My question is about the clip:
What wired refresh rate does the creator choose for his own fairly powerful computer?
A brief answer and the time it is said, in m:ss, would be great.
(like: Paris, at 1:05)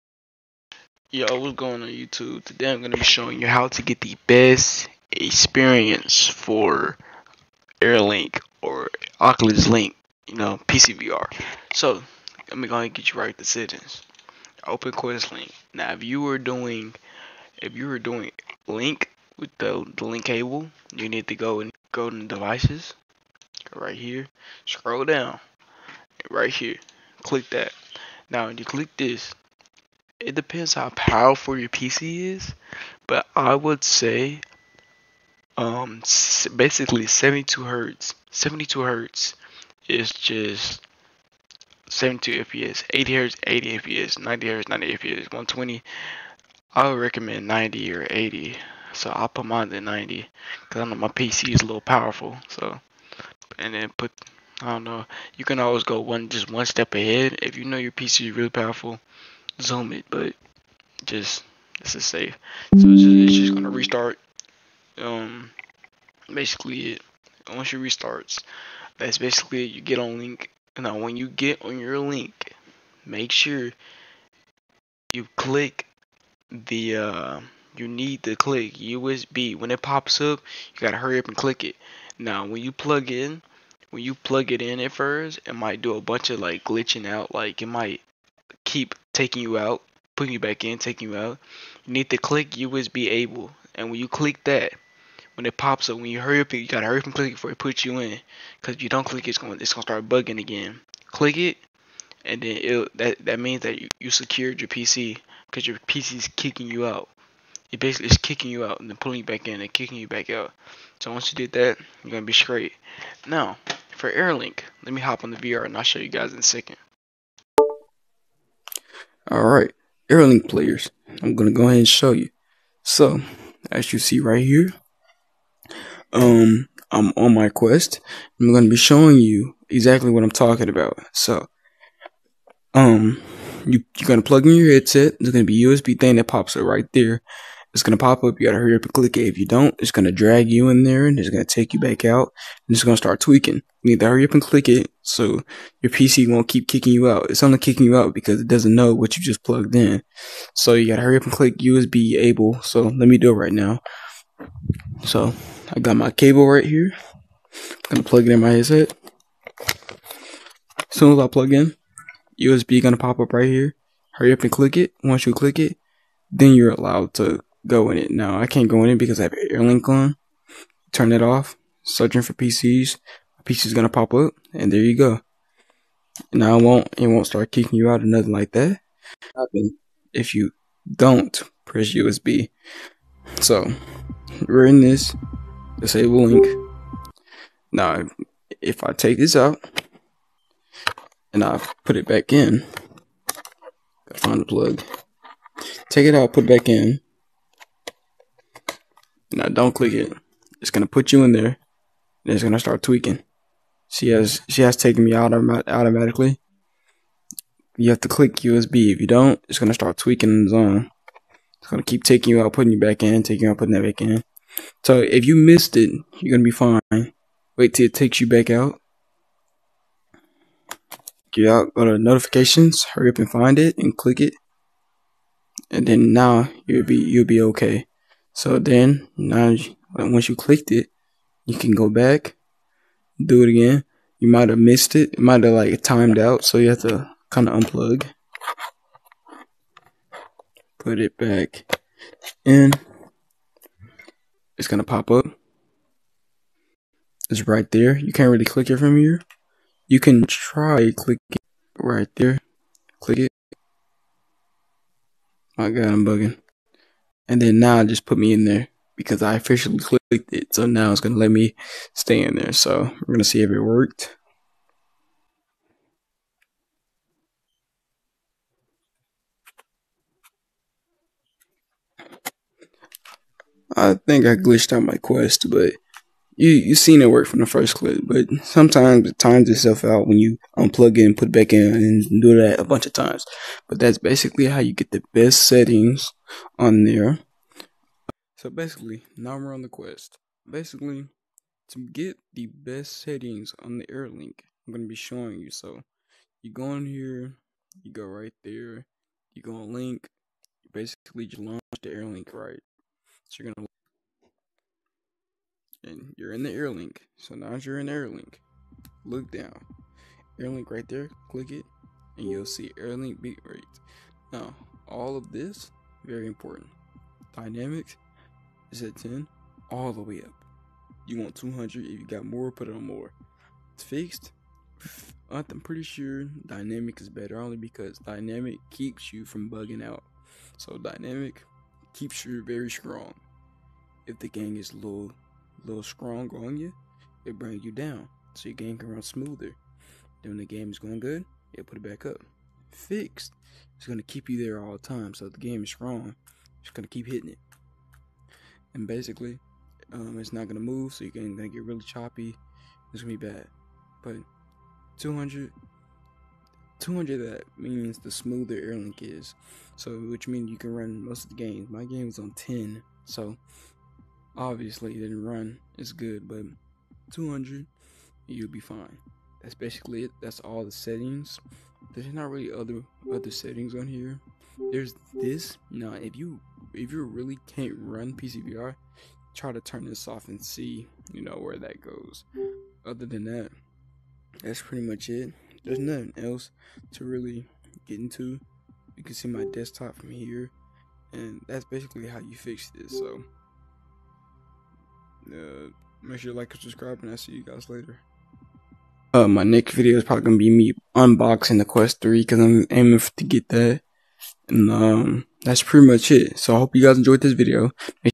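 90 hertz, at 0:48.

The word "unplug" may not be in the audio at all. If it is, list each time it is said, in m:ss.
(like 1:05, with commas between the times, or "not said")
3:57, 4:40.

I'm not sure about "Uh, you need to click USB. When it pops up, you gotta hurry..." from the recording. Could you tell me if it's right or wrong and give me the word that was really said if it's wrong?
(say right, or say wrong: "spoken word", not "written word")
right.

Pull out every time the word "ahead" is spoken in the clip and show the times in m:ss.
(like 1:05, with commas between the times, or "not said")
0:56, 2:01.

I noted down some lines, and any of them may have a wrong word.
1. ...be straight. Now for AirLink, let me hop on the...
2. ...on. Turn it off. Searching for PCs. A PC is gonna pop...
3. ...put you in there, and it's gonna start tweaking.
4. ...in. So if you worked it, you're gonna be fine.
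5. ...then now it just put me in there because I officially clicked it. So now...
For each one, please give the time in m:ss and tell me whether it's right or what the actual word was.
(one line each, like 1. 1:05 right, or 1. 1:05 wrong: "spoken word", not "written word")
1. 1:52 right
2. 2:49 right
3. 3:20 right
4. 3:34 wrong: "missed", not "worked"
5. 4:17 right.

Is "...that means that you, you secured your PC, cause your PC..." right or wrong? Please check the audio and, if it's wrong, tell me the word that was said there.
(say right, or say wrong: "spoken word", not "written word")
right.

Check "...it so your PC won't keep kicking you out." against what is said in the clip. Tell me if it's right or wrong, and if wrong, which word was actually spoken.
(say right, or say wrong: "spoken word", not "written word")
right.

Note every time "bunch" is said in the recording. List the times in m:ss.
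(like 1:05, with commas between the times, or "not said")
1:26, 4:42.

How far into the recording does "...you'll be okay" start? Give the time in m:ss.
3:46.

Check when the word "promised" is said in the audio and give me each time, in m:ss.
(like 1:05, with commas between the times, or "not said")
not said.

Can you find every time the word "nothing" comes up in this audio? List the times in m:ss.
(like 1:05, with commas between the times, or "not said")
2:58, 6:25.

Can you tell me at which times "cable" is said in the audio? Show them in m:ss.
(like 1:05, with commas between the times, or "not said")
0:20, 2:36.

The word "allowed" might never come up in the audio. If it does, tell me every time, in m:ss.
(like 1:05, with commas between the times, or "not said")
2:46.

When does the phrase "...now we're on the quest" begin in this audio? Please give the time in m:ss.
4:49.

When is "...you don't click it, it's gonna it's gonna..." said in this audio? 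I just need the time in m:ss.
1:38.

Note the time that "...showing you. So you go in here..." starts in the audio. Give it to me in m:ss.
4:54.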